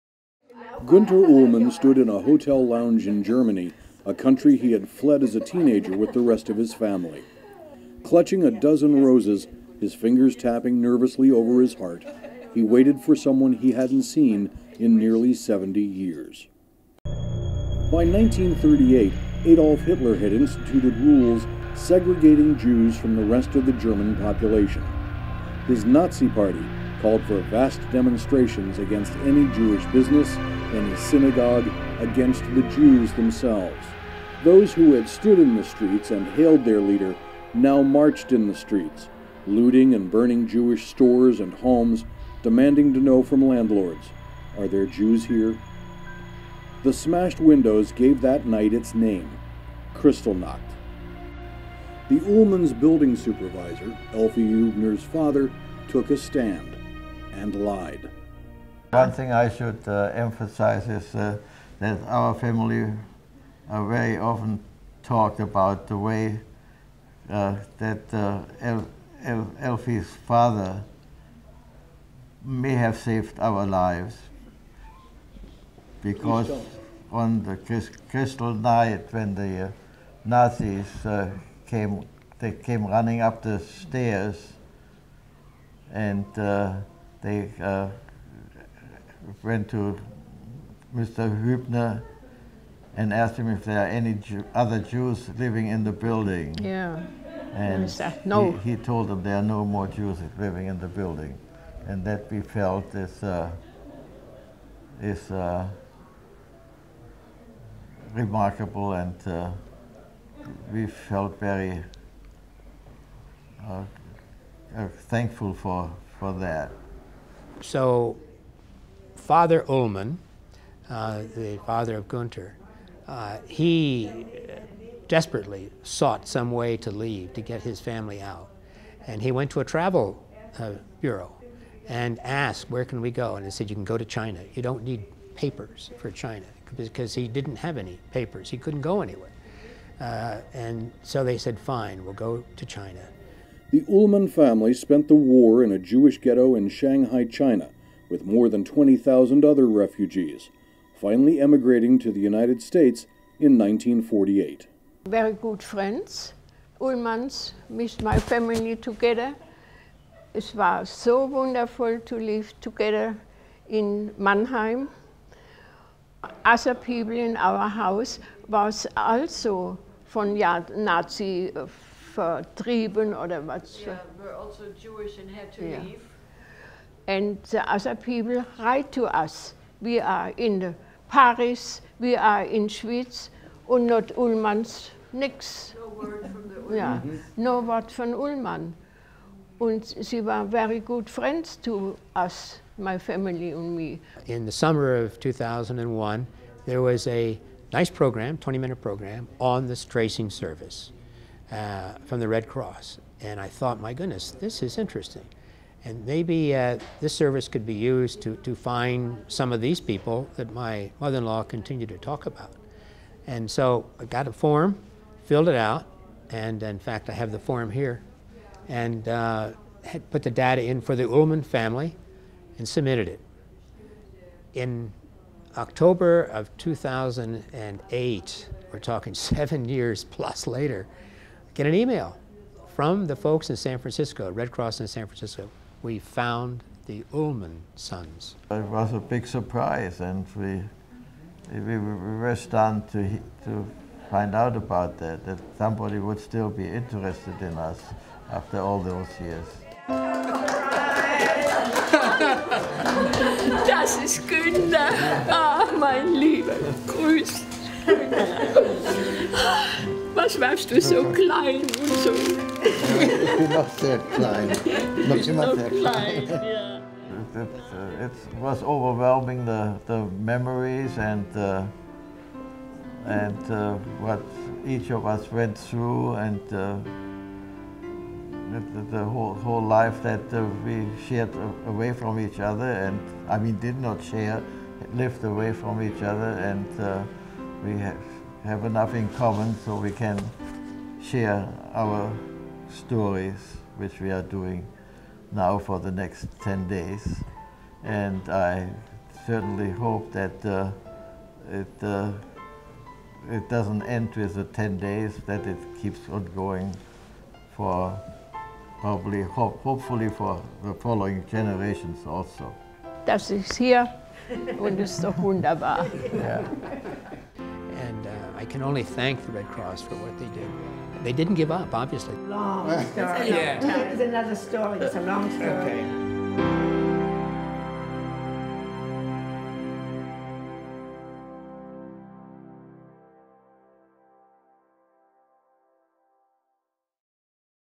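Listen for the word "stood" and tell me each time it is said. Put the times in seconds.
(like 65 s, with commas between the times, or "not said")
1 s, 35 s.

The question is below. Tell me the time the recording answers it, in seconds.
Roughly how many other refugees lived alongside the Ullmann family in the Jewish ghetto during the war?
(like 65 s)
148 s.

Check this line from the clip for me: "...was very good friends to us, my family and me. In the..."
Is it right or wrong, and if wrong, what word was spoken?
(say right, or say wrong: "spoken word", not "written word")
right.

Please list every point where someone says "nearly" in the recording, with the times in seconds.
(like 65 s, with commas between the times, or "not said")
14 s.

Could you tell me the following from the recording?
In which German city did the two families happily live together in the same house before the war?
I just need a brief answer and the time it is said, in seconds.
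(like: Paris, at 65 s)
Mannheim, at 164 s.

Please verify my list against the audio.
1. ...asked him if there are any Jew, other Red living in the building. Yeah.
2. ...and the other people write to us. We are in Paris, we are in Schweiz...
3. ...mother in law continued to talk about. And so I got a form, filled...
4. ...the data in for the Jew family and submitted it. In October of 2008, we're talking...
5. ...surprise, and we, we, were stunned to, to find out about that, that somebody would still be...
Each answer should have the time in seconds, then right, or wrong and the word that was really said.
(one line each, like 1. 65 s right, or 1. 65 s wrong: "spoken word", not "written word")
1. 93 s wrong: "Jews", not "Red"
2. 177 s right
3. 210 s right
4. 220 s wrong: "Ullmann", not "Jew"
5. 239 s right.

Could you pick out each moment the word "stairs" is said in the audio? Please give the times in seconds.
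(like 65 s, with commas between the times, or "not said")
83 s.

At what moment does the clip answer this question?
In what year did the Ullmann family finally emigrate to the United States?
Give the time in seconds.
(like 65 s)
153 s.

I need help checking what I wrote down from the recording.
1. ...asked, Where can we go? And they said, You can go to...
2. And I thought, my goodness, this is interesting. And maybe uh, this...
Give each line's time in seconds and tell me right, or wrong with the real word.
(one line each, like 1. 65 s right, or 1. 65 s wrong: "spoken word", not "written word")
1. 132 s right
2. 203 s right.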